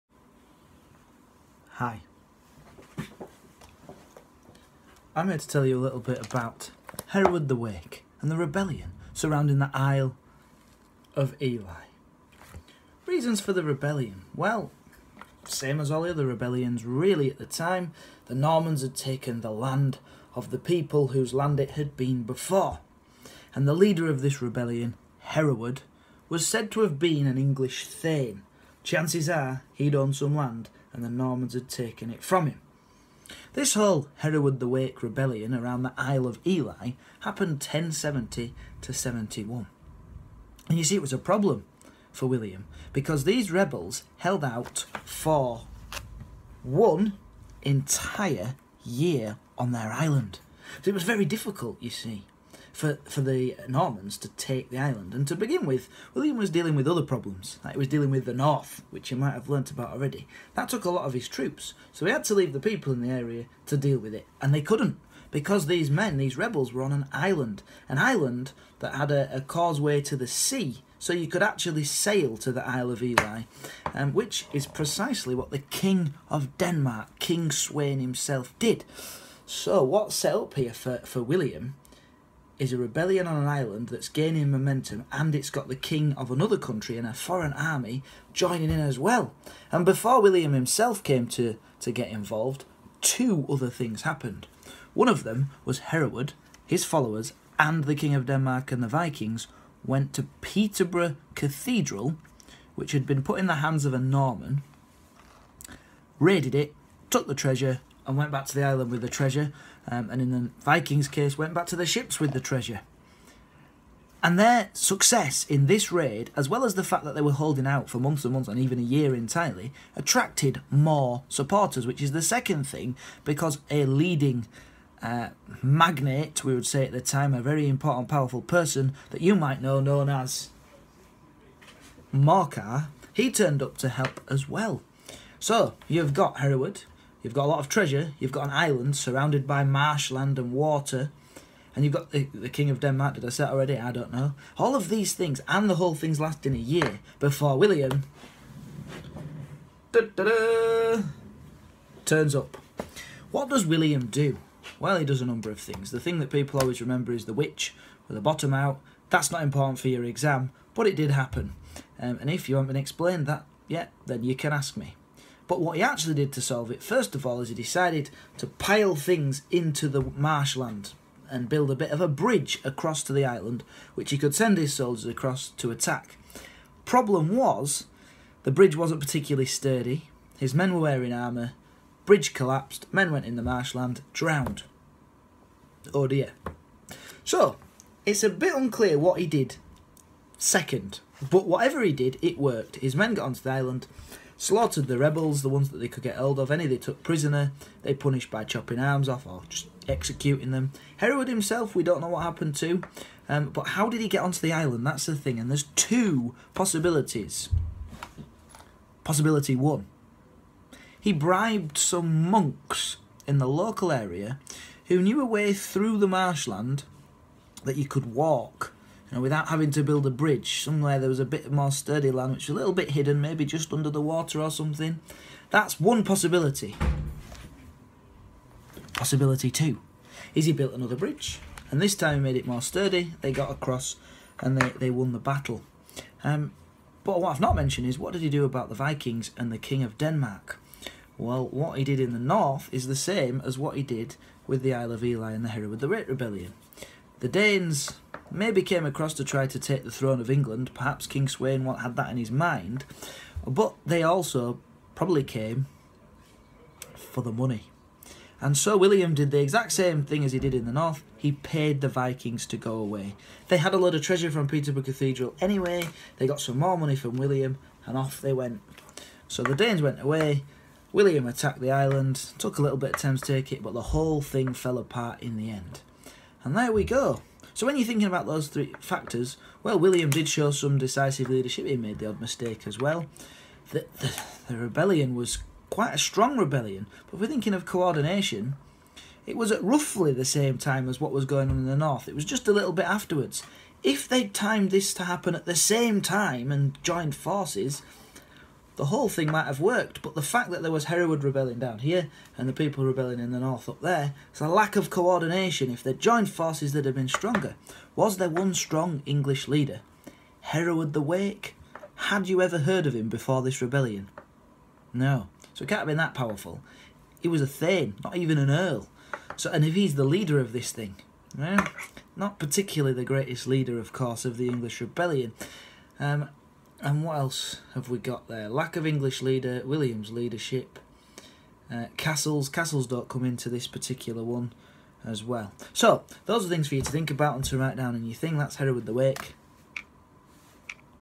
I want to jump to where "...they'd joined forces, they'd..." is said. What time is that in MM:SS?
05:05.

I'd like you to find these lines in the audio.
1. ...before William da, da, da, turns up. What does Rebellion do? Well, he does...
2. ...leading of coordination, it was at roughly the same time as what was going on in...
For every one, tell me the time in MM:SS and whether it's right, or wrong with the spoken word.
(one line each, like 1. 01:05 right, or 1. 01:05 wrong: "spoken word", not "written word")
1. 02:27 wrong: "William", not "Rebellion"
2. 04:47 wrong: "thinking", not "leading".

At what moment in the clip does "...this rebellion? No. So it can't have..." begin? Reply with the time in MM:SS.
05:13.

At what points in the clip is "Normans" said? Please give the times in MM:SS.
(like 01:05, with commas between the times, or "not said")
00:18, 00:31, 00:53, 01:43.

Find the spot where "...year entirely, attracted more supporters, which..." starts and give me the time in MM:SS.
01:58.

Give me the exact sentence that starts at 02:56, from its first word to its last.
Problem was, the bridge wasn't particularly sturdy, his men were wearing armour, bridge collapsed, men went in the marshland, drowned.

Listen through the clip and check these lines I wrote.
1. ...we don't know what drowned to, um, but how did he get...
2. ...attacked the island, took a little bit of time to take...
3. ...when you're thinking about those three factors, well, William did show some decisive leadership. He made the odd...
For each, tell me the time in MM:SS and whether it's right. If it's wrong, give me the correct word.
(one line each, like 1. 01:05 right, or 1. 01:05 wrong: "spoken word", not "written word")
1. 03:21 wrong: "happened", not "drowned"
2. 04:31 right
3. 04:37 right.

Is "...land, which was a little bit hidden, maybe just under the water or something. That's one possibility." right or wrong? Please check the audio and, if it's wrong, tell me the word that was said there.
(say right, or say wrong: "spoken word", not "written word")
right.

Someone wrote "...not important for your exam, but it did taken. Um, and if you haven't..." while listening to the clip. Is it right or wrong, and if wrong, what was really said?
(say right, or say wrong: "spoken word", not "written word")
wrong: "happen", not "taken".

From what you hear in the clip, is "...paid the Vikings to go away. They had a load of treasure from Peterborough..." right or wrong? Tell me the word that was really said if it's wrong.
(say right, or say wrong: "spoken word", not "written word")
right.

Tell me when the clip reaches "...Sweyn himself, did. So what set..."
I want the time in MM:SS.
01:17.